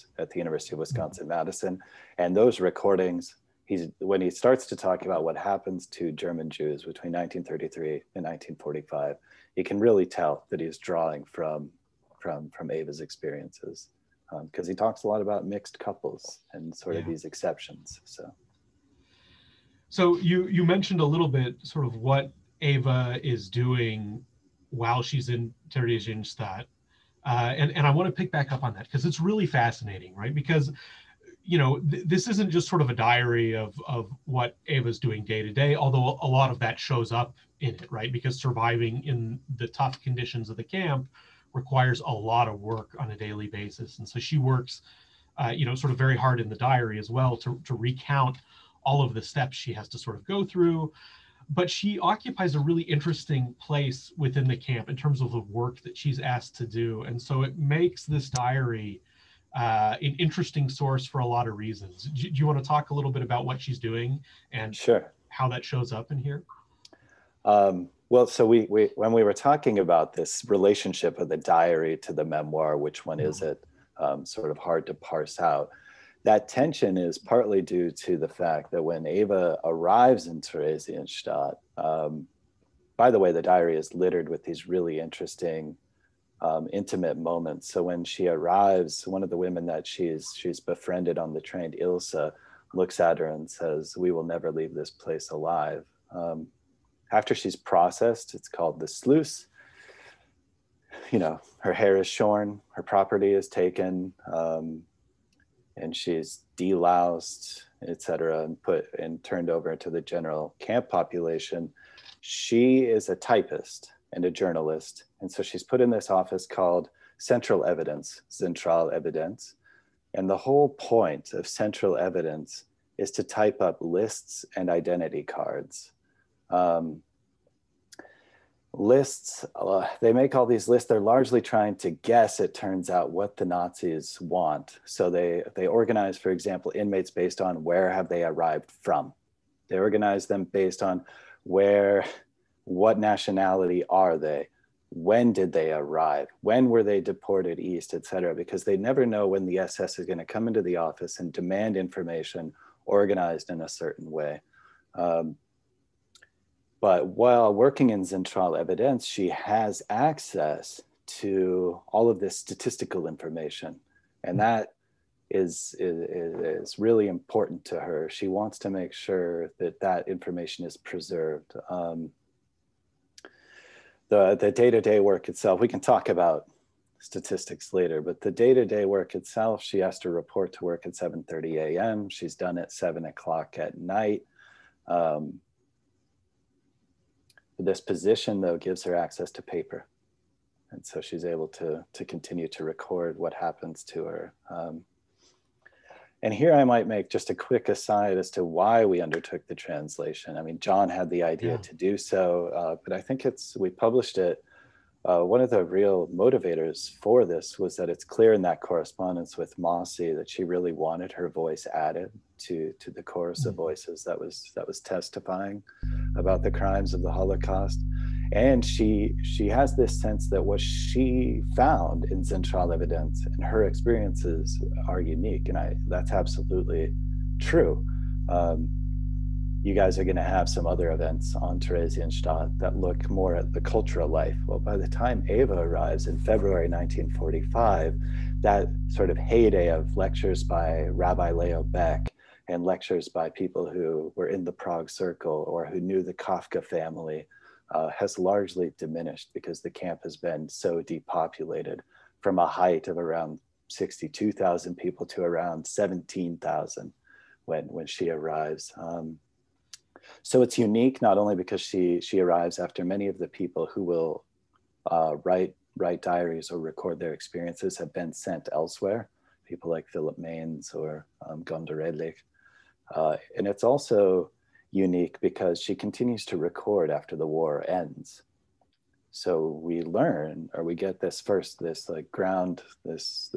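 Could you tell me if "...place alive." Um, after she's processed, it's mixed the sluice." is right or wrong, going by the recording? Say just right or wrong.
wrong.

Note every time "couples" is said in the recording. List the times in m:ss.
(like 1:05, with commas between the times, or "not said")
0:15.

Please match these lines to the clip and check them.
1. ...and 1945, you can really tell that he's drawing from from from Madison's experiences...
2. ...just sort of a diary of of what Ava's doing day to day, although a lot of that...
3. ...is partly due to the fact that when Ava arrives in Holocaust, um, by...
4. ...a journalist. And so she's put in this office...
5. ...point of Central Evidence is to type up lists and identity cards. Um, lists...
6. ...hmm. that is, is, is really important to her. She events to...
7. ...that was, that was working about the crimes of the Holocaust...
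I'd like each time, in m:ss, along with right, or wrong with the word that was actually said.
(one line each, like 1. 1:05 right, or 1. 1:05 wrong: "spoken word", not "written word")
1. 0:08 wrong: "Ava", not "Madison"
2. 0:32 right
3. 1:16 wrong: "Theresienstadt", not "Holocaust"
4. 1:54 right
5. 2:00 right
6. 2:44 wrong: "wants", not "events"
7. 3:34 wrong: "testifying", not "working".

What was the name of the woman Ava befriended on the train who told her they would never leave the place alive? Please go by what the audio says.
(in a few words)
Ilsa.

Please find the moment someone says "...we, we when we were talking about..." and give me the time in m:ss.
1:08.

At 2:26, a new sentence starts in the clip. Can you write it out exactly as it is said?
When were they deported east, et cetera?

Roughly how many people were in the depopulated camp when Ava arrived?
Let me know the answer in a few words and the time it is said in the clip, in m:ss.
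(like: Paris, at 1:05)
17,000, at 4:15.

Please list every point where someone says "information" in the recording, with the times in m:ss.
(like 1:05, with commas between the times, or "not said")
2:31, 2:43, 2:50.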